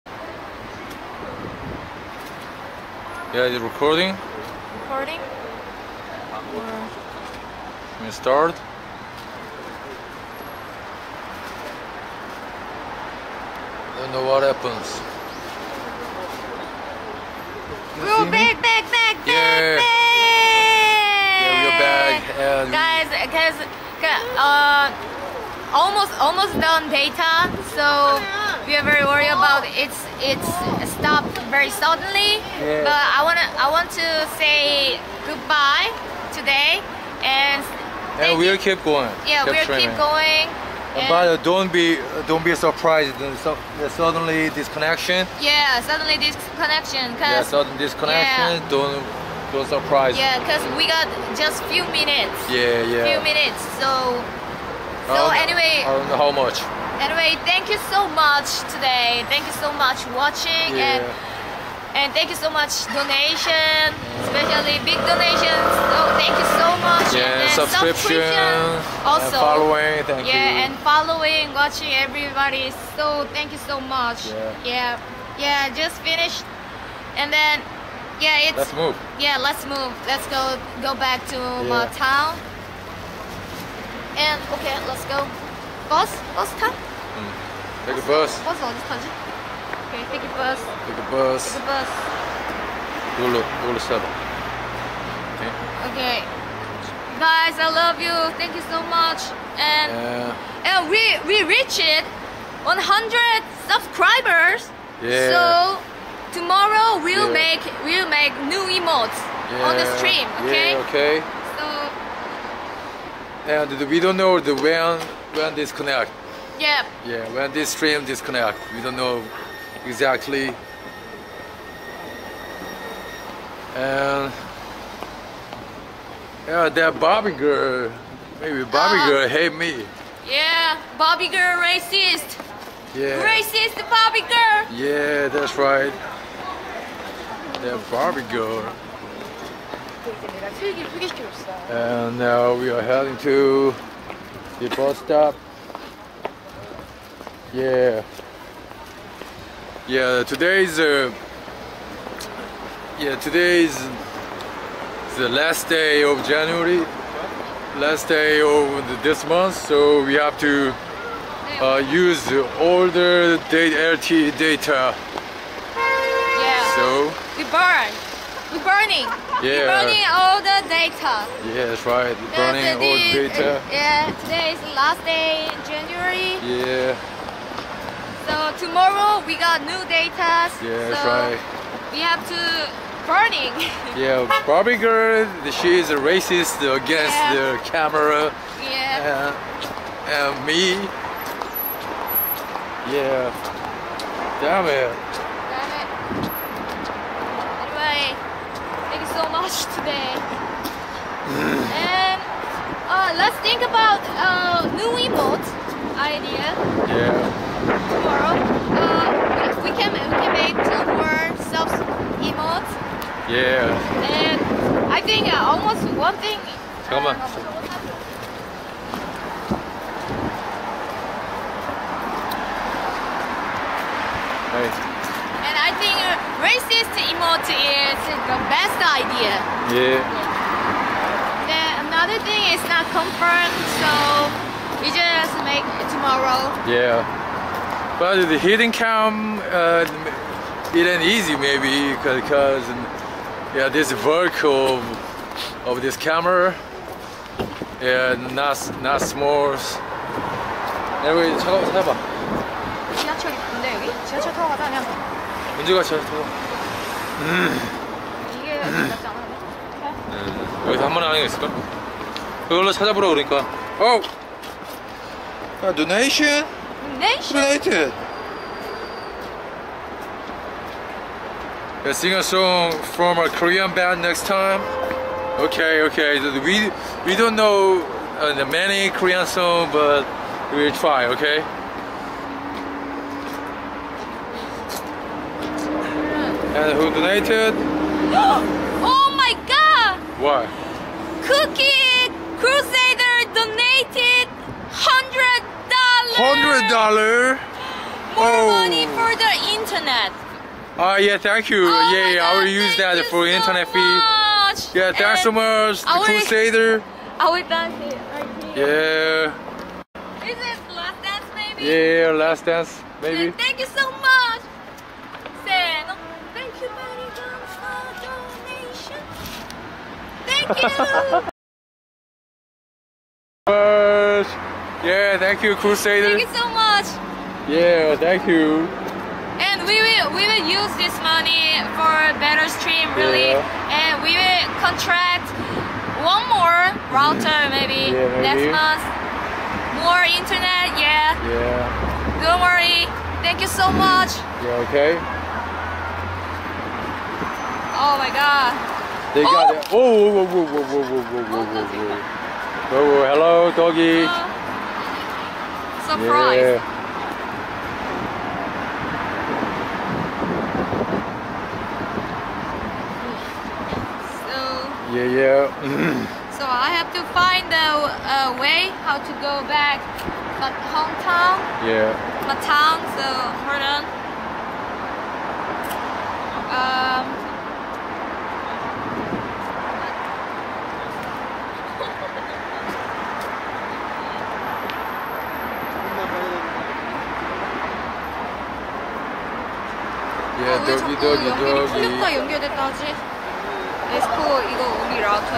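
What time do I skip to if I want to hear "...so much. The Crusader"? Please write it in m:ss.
5:05.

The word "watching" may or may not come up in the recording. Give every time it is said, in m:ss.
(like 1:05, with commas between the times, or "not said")
1:00, 1:11.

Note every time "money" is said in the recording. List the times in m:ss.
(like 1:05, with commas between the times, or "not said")
4:58, 5:31.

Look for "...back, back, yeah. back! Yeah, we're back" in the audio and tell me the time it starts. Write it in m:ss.
0:18.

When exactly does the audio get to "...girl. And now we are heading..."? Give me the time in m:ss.
2:18.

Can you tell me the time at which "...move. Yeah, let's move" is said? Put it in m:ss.
1:18.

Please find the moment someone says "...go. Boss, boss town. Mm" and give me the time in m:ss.
1:25.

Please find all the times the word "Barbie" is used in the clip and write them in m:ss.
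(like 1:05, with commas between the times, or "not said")
2:17, 3:04.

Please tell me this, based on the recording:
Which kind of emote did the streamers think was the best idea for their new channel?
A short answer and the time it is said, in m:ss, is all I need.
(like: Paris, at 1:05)
Racist emote, at 3:46.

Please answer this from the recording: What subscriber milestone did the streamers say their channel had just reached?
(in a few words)
100 subscribers.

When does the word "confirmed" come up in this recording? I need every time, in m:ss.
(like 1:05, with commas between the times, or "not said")
3:52.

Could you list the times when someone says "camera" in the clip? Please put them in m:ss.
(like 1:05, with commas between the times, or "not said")
3:07, 4:05.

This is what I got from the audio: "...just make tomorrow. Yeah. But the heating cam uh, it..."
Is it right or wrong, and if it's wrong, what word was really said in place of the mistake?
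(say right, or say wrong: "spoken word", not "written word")
right.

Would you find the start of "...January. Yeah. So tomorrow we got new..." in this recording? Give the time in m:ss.
2:55.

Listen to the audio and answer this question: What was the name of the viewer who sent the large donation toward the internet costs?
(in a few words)
Cookie Crusader.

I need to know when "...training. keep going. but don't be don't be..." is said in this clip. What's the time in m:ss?
0:39.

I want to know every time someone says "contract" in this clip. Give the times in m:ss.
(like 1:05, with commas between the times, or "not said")
5:34.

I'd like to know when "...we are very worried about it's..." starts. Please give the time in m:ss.
0:28.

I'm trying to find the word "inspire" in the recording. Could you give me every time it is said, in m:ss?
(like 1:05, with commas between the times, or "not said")
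not said.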